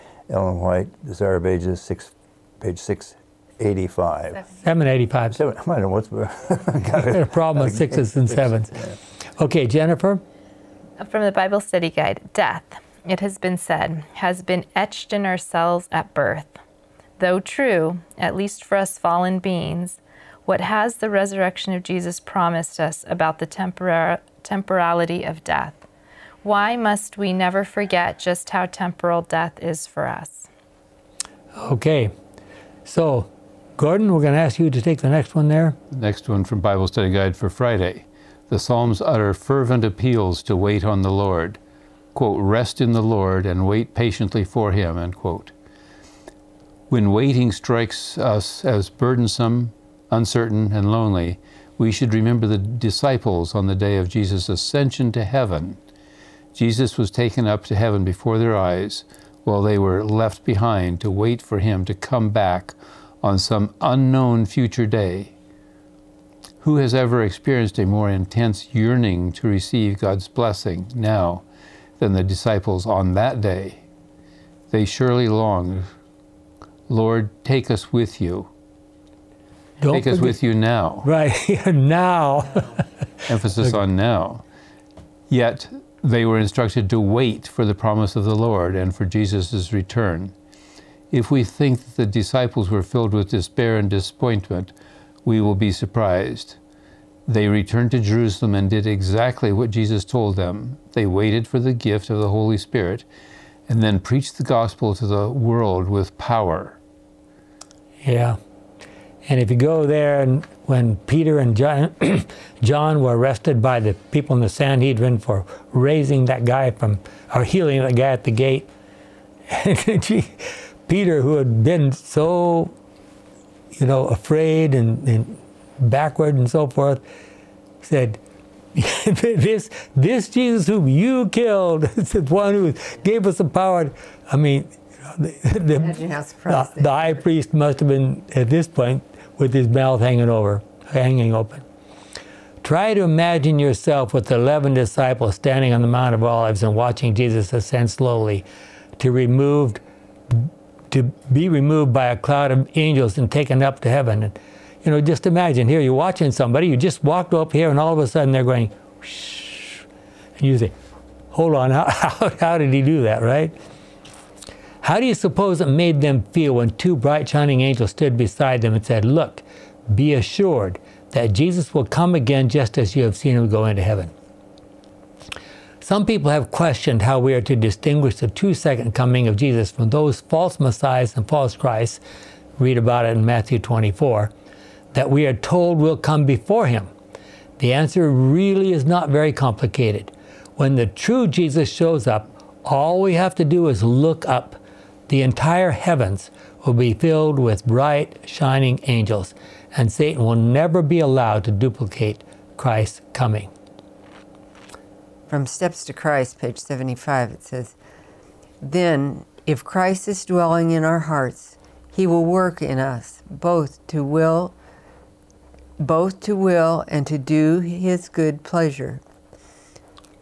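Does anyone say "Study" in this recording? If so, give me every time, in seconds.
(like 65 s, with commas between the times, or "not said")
11 s, 36 s.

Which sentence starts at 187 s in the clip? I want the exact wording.
The answer really is not very complicated.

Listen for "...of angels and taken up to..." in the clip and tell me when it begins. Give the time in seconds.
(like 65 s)
152 s.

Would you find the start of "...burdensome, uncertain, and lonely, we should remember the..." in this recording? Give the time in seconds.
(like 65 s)
48 s.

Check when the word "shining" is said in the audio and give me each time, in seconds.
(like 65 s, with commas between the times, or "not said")
167 s, 198 s.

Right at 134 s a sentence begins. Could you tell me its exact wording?
I mean, the, the, the, the high priest must have been at this point with his mouth hanging over, hanging open.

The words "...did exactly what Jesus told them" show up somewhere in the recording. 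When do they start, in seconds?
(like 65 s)
98 s.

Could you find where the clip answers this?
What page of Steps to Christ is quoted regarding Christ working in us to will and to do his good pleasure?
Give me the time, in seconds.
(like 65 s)
206 s.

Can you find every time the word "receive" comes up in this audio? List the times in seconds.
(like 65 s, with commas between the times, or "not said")
69 s.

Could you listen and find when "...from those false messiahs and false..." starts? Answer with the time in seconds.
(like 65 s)
179 s.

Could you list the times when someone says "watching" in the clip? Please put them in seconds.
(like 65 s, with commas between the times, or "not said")
146 s, 155 s.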